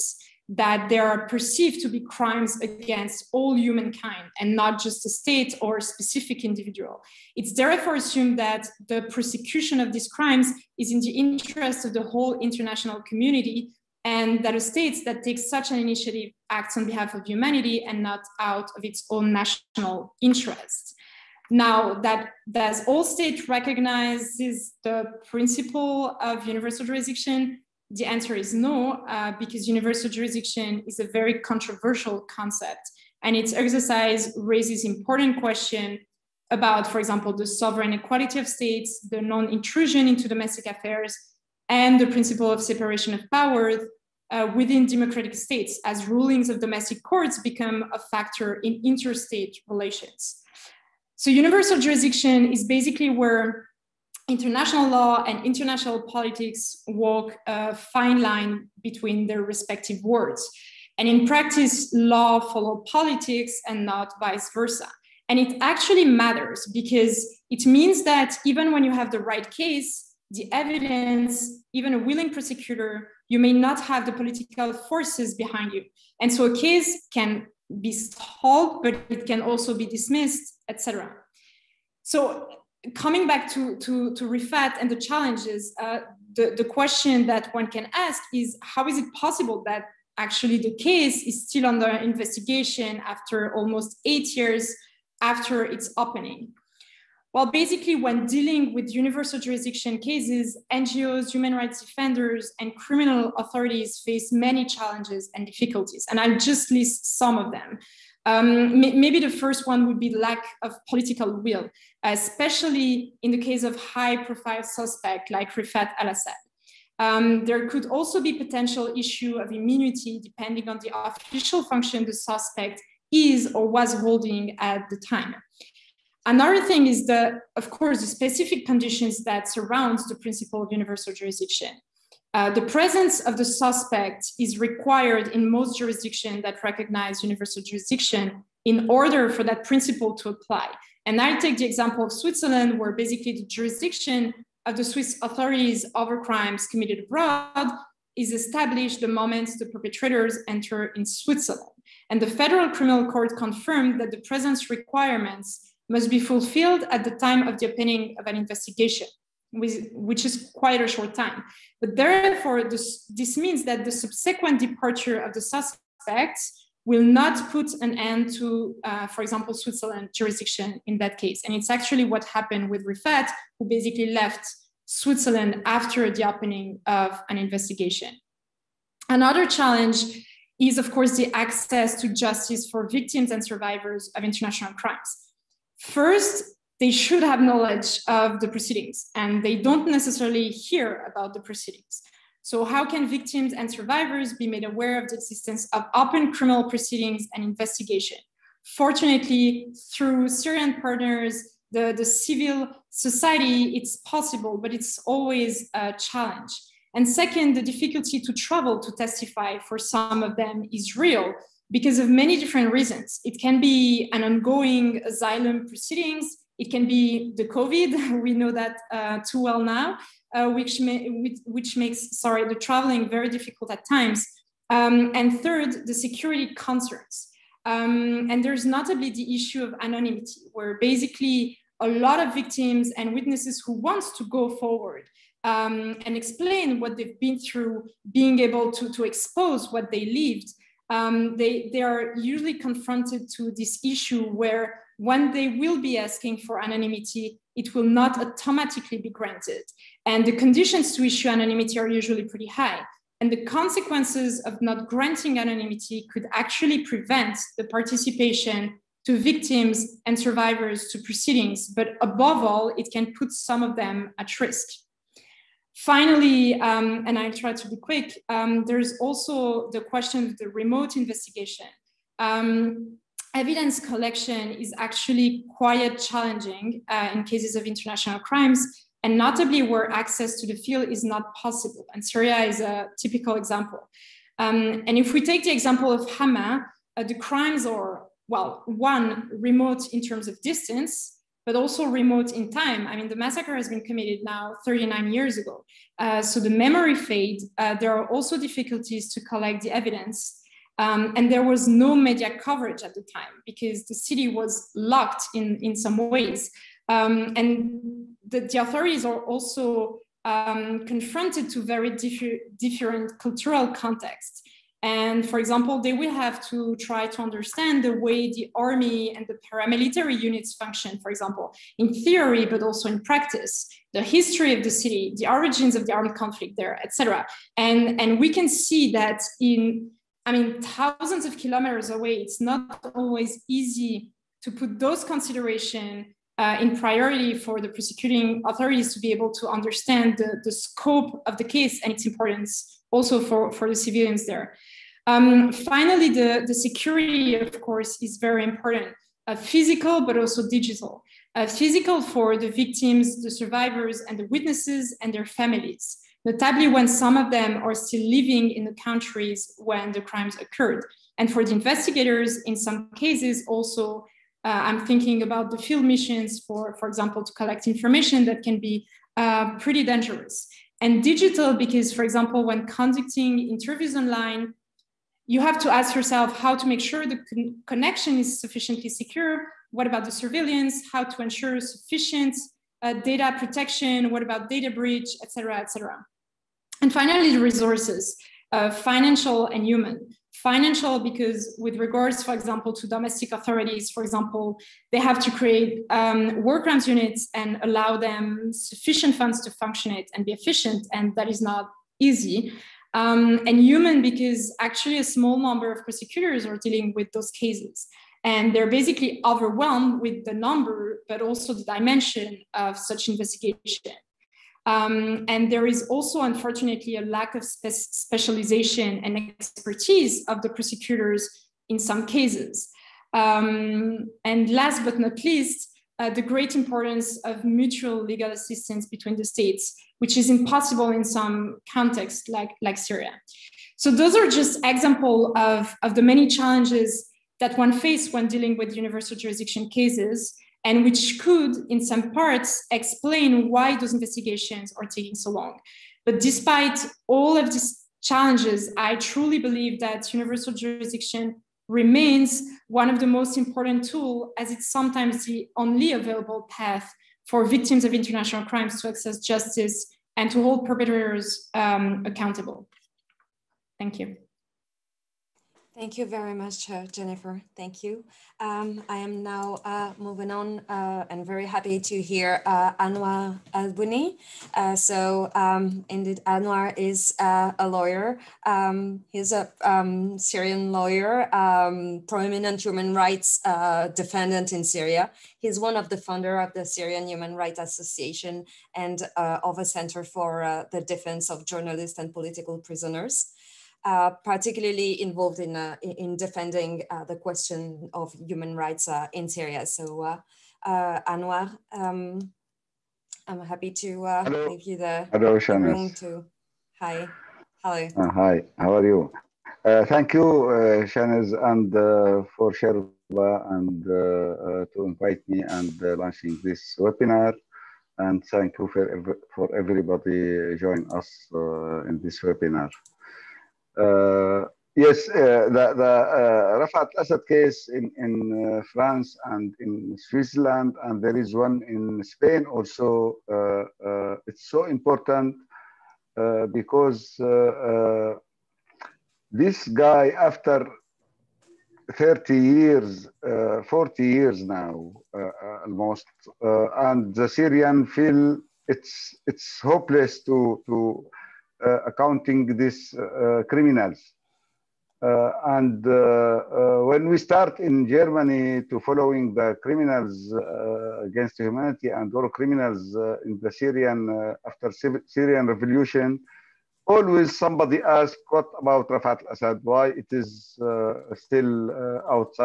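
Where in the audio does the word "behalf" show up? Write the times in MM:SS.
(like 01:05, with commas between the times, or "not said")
00:16.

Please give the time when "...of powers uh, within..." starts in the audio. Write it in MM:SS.
00:43.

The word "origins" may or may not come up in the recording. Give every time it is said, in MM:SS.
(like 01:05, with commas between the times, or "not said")
05:25.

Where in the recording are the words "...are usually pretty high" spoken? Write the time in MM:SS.
04:11.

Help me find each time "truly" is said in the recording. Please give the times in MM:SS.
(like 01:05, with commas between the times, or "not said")
07:28.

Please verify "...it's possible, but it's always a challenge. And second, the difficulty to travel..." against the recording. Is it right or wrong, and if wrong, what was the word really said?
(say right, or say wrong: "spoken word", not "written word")
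right.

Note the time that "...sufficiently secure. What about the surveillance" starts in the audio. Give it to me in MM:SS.
06:18.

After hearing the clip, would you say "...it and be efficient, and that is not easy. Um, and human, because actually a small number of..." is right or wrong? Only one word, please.
right.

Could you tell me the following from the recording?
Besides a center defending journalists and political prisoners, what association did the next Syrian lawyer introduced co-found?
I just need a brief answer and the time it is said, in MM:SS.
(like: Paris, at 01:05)
Syrian Human Rights Association, at 08:06.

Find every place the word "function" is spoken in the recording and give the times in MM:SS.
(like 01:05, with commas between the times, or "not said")
02:01, 05:20, 06:39.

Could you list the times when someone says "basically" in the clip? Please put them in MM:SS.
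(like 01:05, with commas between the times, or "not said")
00:52, 01:37, 02:22, 02:53, 03:50, 06:48.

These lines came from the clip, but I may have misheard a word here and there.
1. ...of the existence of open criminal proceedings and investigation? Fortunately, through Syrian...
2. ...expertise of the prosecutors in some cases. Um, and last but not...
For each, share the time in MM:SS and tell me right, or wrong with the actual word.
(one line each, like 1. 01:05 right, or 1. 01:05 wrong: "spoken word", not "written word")
1. 03:15 right
2. 06:59 right.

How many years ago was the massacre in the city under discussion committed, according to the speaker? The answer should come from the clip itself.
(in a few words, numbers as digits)
39.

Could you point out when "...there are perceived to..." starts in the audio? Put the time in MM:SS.
00:00.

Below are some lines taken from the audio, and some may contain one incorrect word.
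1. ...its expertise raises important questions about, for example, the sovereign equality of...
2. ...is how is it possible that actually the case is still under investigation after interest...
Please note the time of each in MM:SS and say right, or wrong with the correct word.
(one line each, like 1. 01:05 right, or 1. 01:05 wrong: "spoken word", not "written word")
1. 00:33 wrong: "exercise", not "expertise"
2. 01:28 wrong: "almost", not "interest".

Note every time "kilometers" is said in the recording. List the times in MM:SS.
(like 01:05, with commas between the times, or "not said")
05:31.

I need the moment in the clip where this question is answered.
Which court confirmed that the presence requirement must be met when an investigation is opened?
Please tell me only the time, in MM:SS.
02:32.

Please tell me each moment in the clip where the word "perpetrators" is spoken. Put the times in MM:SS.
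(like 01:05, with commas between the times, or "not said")
02:29, 07:40.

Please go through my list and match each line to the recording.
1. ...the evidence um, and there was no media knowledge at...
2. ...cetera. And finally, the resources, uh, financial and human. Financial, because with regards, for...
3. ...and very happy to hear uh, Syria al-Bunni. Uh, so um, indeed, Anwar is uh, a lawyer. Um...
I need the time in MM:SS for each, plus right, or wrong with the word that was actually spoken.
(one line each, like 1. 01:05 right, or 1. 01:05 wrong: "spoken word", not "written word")
1. 04:59 wrong: "coverage", not "knowledge"
2. 06:25 right
3. 07:51 wrong: "Anwar", not "Syria".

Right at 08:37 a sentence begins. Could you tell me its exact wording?
And thank you for, for everybody joining us in this webinar.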